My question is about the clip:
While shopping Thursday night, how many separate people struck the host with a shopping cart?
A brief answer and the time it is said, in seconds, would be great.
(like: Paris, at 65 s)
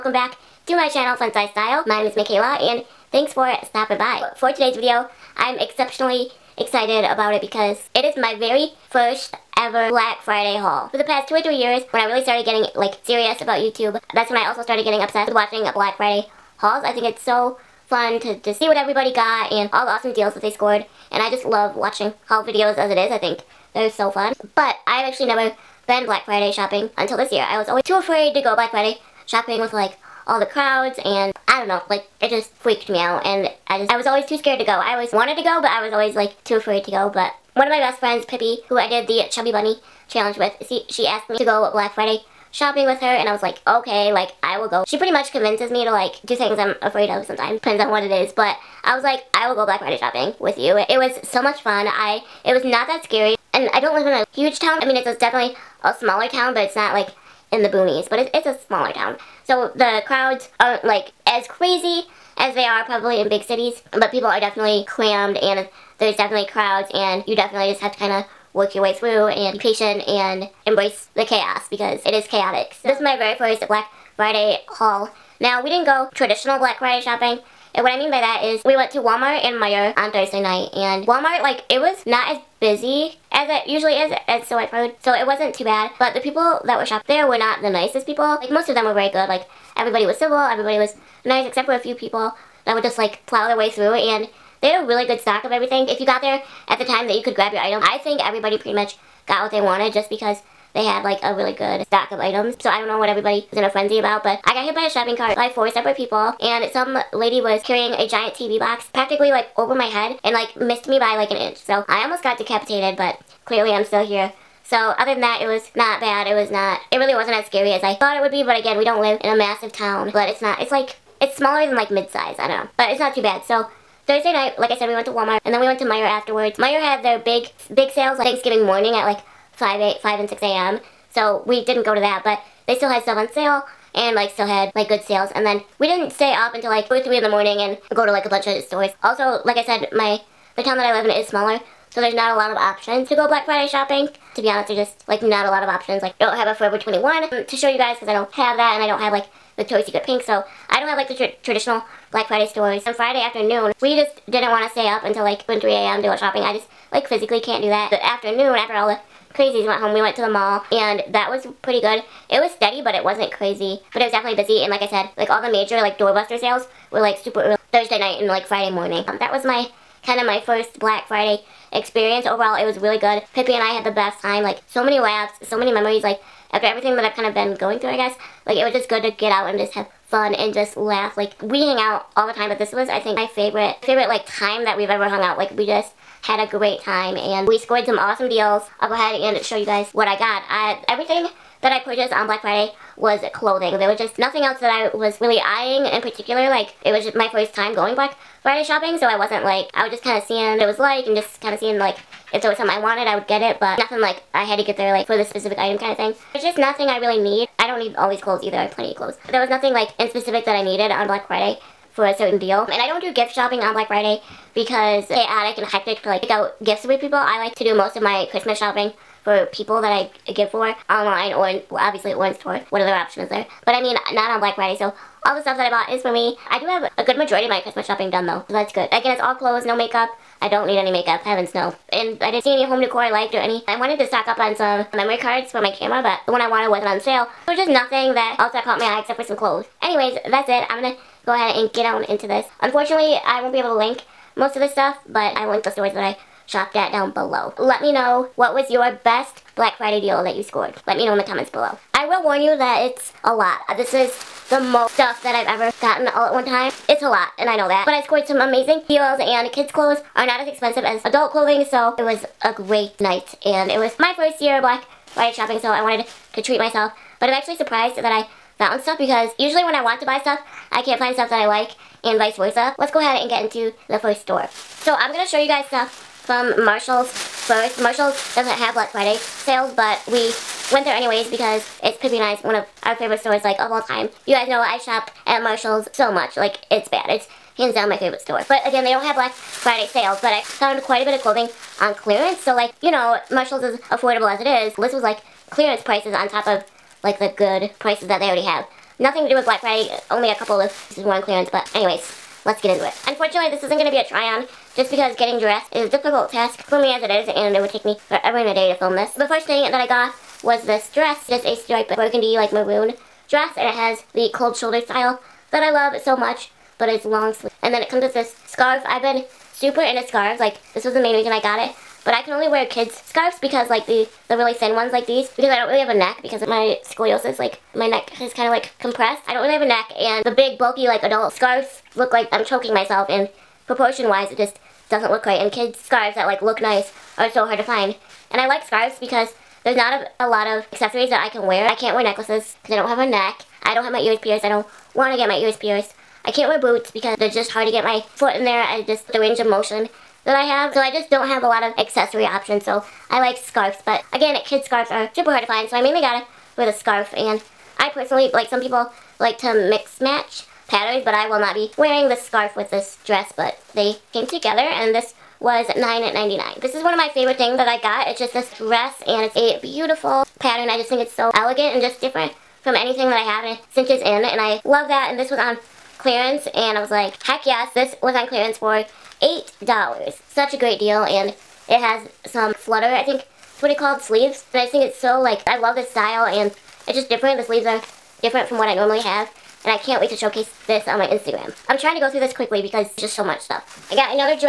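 4, at 105 s.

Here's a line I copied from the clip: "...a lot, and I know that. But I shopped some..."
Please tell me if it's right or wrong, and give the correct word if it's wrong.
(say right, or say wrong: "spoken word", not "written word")
wrong: "scored", not "shopped".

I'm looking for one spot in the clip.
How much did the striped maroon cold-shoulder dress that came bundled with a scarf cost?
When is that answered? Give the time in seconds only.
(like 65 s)
365 s.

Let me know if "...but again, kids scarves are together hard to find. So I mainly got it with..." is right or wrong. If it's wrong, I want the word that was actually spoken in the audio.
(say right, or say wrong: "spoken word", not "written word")
wrong: "super", not "together".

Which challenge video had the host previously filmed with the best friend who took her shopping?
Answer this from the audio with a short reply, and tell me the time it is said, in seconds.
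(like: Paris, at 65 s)
Chubby Bunny challenge, at 39 s.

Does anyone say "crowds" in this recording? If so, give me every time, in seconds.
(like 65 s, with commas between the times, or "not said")
30 s, 60 s, 66 s.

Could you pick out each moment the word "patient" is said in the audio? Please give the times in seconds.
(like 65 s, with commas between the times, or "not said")
69 s.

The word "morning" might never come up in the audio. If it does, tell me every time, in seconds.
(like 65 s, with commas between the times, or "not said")
128 s, 137 s, 168 s.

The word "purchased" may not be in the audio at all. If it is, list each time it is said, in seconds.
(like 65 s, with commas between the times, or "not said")
191 s.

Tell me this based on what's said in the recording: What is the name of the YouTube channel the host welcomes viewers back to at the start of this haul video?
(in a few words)
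Fun Size Style.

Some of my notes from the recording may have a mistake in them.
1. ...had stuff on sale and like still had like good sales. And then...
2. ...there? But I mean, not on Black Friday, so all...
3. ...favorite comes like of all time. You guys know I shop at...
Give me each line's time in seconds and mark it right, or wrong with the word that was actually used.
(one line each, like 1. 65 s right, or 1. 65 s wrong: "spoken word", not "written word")
1. 132 s right
2. 223 s right
3. 282 s wrong: "stores", not "comes".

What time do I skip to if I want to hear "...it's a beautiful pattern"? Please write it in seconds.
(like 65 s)
369 s.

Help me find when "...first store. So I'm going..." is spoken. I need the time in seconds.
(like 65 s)
273 s.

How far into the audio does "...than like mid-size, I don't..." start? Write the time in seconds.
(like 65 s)
121 s.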